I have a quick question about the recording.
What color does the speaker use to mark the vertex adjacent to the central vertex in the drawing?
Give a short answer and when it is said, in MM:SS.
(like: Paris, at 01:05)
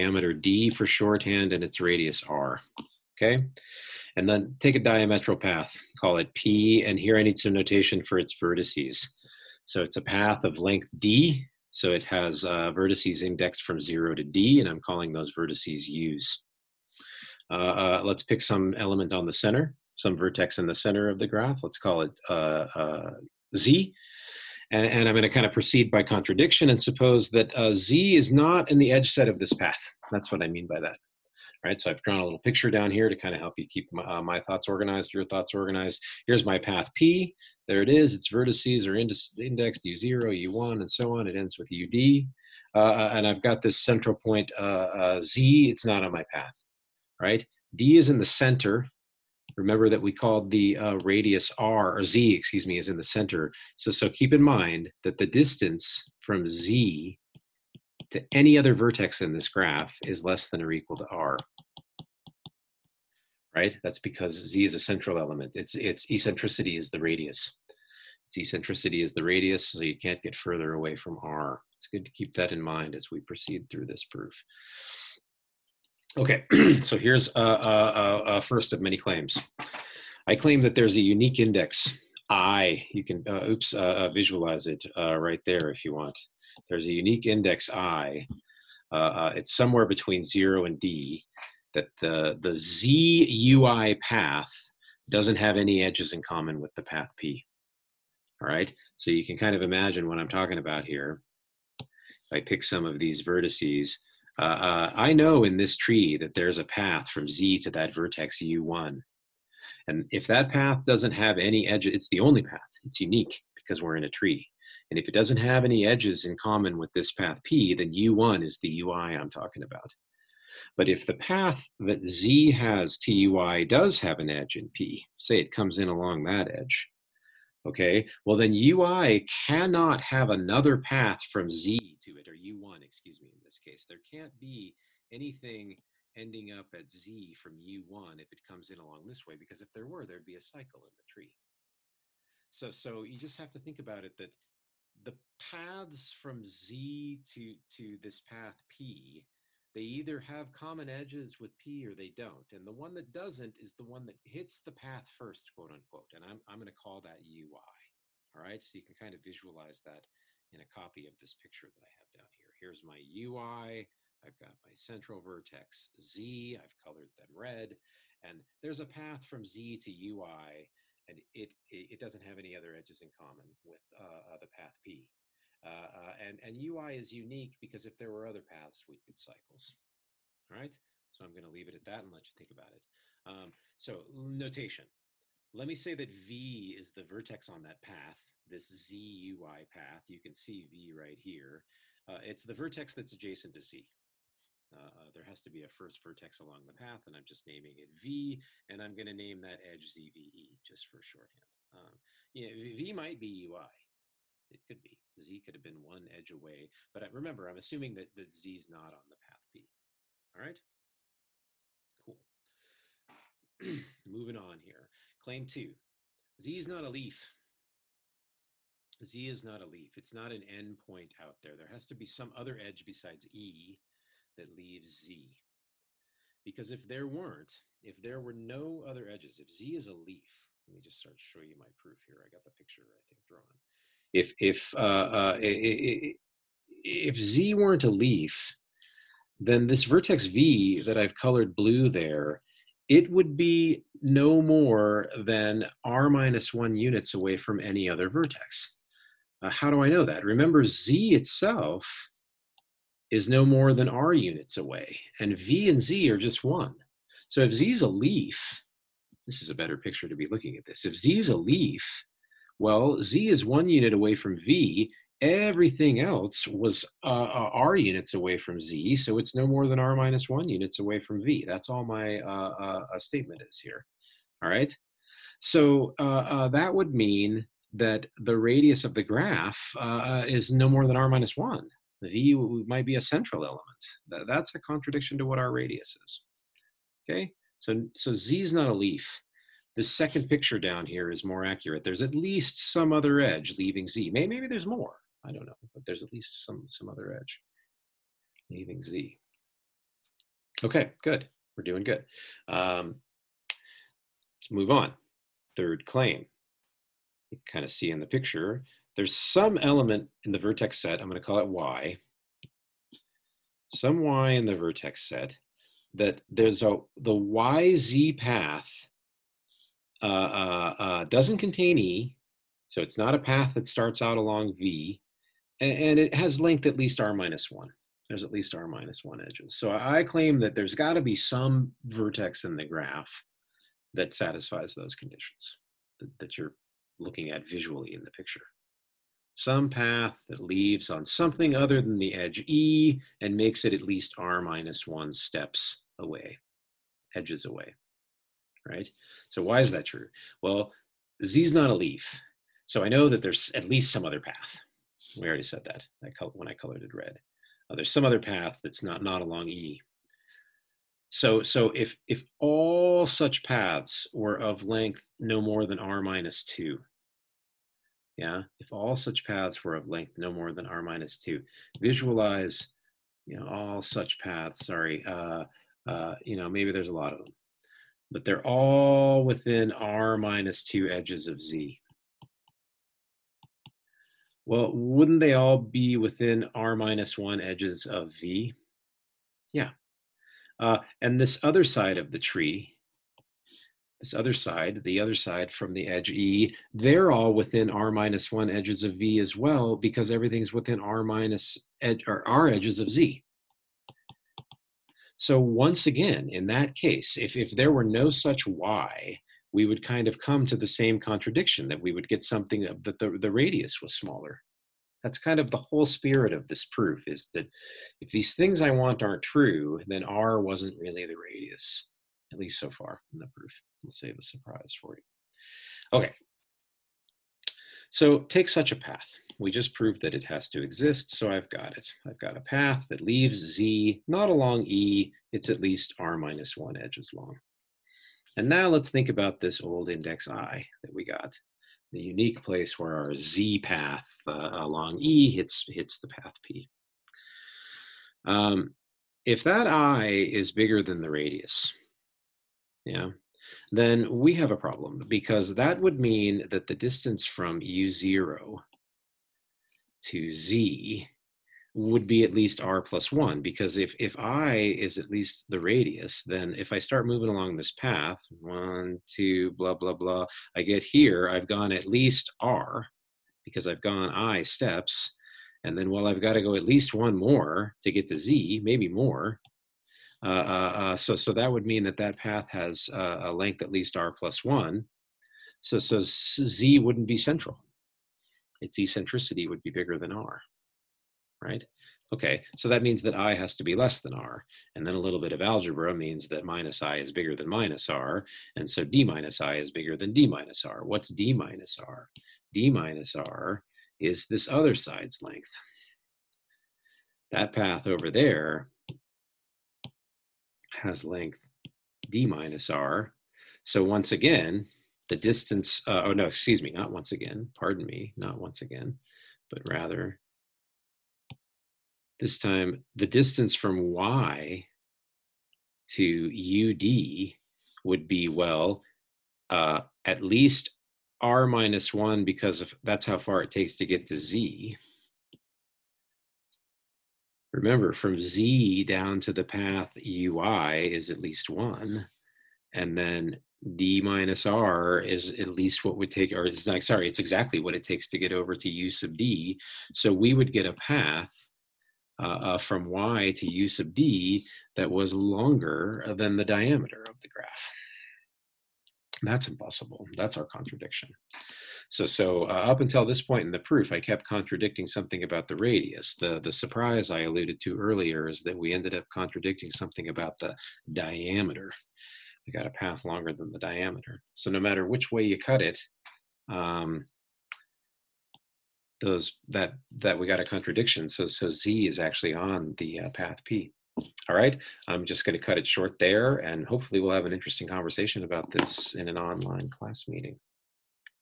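Blue, at 04:01.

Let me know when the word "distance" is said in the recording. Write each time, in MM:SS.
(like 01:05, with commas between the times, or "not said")
00:55, 07:36, 08:35, 08:43.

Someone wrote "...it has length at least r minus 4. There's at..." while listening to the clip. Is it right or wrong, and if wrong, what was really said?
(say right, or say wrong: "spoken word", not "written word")
wrong: "1", not "4".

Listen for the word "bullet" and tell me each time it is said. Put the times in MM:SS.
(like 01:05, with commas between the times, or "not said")
not said.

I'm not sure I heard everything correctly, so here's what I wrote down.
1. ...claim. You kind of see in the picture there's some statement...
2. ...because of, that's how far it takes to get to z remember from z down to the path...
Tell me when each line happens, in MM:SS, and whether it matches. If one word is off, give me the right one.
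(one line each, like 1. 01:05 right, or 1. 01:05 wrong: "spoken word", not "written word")
1. 05:05 wrong: "element", not "statement"
2. 08:52 right.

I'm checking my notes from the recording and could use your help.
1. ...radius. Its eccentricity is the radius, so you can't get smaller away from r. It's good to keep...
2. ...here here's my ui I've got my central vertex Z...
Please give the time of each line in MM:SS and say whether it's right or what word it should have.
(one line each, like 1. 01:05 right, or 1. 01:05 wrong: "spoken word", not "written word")
1. 01:06 wrong: "further", not "smaller"
2. 02:42 right.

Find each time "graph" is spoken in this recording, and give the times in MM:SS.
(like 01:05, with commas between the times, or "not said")
00:21, 00:59, 04:39, 05:32, 09:17.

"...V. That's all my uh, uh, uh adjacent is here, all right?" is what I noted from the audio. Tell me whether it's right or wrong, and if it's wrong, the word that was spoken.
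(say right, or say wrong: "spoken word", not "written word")
wrong: "statement", not "adjacent".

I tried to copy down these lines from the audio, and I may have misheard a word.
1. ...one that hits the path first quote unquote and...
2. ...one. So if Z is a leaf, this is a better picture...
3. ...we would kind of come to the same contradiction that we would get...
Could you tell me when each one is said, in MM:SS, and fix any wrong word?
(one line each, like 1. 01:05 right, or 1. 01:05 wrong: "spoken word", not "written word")
1. 02:33 right
2. 04:16 right
3. 06:49 right.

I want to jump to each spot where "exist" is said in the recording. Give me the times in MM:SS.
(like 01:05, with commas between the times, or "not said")
07:10.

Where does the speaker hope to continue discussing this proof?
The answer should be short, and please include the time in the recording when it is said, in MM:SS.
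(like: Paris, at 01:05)
An online class meeting, at 09:49.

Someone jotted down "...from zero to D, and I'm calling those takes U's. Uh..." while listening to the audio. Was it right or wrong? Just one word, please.
wrong.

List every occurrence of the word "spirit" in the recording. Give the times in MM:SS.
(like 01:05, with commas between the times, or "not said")
06:55.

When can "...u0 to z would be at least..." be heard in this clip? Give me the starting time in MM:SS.
07:37.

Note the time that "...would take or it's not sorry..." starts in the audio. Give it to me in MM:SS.
09:05.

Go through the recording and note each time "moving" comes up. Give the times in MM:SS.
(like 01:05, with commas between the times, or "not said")
03:34, 07:47.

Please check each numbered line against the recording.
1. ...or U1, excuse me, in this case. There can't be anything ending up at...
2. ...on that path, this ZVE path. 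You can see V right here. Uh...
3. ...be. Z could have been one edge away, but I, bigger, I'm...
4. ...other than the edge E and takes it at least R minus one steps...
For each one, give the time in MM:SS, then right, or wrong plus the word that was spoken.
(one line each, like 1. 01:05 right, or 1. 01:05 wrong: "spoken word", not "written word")
1. 02:12 right
2. 03:07 wrong: "ZUI", not "ZVE"
3. 03:24 wrong: "remember", not "bigger"
4. 05:41 wrong: "makes", not "takes".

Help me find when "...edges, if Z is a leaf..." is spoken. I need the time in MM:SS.
03:49.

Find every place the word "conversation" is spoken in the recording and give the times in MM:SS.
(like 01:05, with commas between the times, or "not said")
09:47.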